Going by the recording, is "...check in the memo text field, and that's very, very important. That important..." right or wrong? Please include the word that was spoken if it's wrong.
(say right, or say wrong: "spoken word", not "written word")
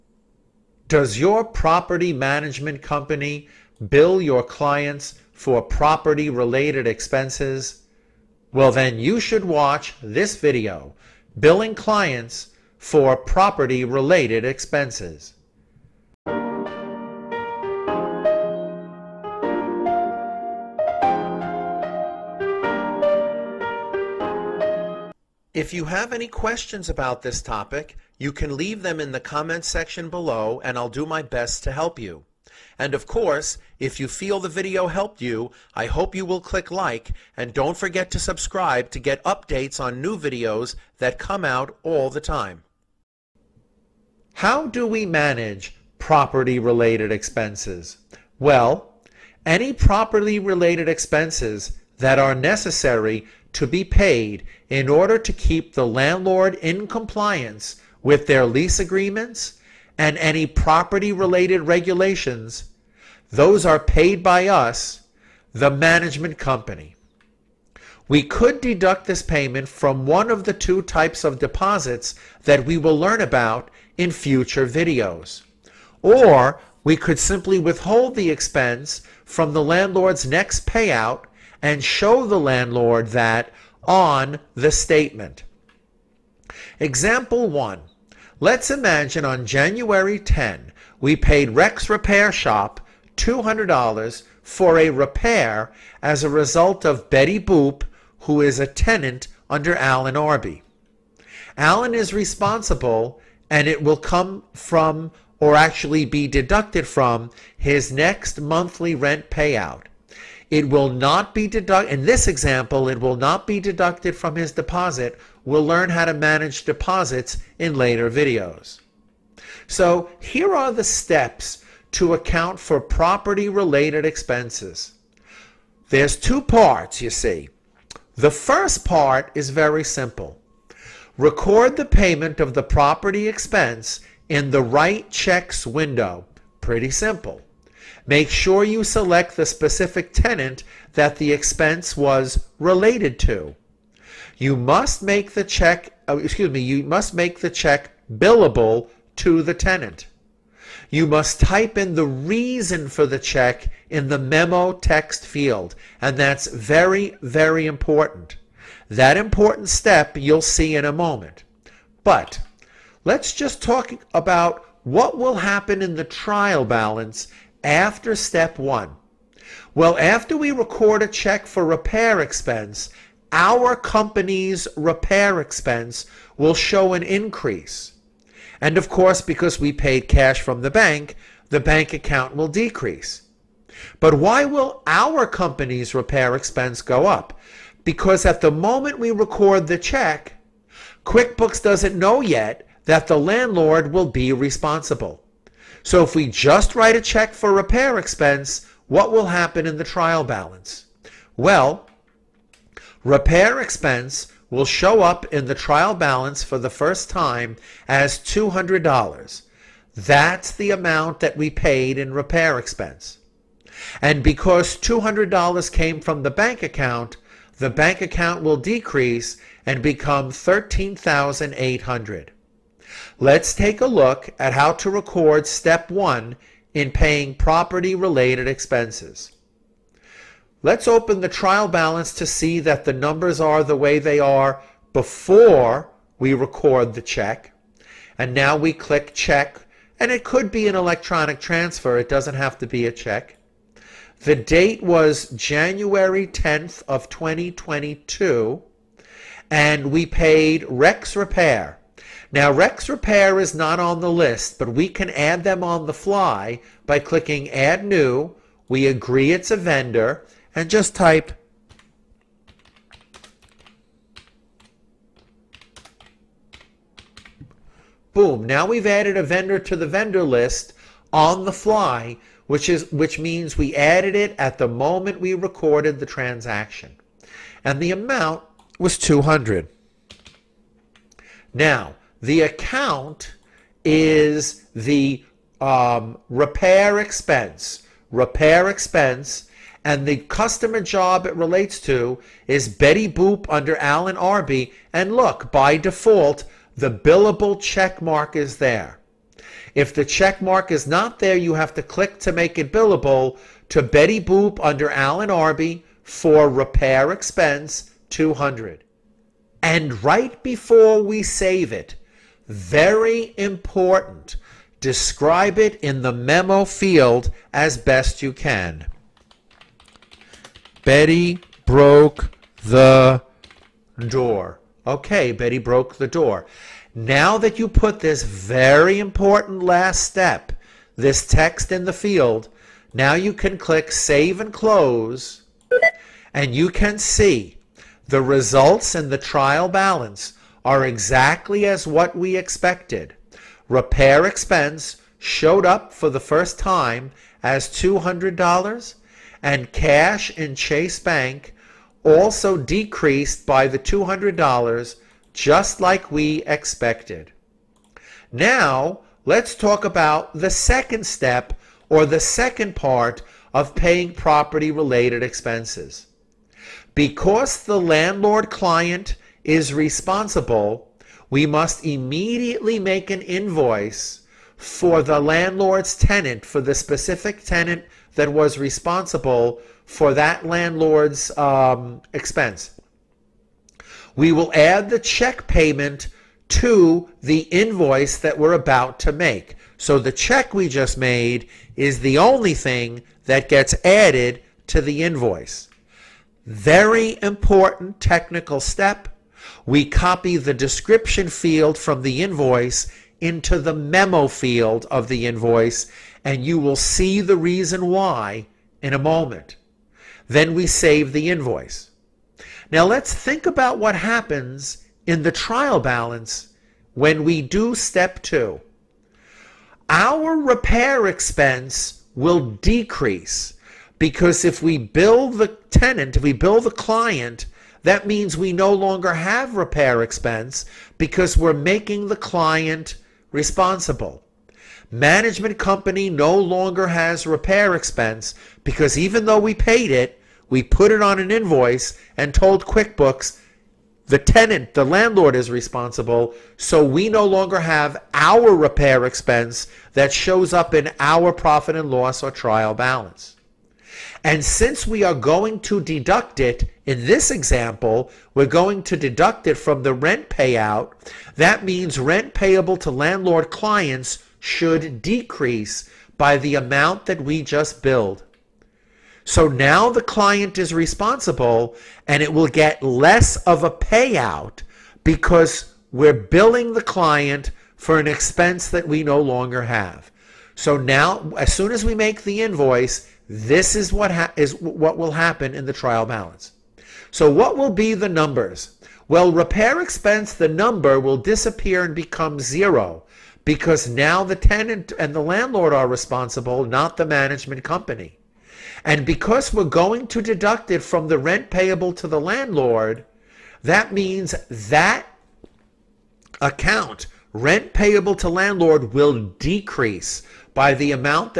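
right.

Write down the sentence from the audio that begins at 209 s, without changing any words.
That's the amount that we paid in repair expense.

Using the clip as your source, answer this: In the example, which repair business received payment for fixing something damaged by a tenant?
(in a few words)
Rex Repair Shop.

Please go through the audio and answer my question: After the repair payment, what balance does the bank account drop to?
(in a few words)
13,800.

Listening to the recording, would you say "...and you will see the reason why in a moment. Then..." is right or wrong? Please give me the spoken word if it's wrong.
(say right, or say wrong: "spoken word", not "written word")
right.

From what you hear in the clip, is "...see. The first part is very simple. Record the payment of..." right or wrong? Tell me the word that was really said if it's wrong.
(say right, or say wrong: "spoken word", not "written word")
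right.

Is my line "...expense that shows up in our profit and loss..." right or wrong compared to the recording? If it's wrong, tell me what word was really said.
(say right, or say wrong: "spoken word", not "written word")
right.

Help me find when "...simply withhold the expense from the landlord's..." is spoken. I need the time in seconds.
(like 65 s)
77 s.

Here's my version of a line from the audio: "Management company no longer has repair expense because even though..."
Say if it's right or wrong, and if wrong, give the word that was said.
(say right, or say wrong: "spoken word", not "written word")
right.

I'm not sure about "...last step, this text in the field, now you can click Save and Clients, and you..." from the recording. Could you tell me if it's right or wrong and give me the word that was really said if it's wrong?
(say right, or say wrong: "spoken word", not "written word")
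wrong: "Close", not "Clients".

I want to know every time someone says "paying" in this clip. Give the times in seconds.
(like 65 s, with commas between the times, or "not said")
226 s, 363 s.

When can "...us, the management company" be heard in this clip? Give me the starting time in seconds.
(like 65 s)
64 s.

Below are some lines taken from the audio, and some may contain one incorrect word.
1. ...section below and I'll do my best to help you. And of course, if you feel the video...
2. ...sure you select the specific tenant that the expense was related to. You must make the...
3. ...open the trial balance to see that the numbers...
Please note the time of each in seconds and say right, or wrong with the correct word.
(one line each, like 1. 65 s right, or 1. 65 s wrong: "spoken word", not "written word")
1. 29 s right
2. 138 s right
3. 230 s right.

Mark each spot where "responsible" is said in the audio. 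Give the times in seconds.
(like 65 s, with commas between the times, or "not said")
102 s, 194 s, 369 s, 378 s, 433 s, 445 s, 470 s, 495 s.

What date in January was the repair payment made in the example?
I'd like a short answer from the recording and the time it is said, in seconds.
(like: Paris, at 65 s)
January 10, at 89 s.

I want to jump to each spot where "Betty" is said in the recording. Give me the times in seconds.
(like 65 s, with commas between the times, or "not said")
97 s, 292 s, 303 s, 320 s, 325 s.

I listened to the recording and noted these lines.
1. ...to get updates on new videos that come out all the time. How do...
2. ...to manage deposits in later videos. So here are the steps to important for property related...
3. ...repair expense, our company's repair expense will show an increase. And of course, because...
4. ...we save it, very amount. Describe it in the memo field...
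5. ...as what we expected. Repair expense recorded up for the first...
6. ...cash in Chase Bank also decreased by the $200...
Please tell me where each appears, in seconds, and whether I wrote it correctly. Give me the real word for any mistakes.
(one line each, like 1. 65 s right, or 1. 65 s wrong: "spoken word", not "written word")
1. 38 s right
2. 116 s wrong: "account", not "important"
3. 171 s right
4. 311 s wrong: "important", not "amount"
5. 341 s wrong: "showed", not "recorded"
6. 349 s right.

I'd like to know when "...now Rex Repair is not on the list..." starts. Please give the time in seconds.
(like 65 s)
252 s.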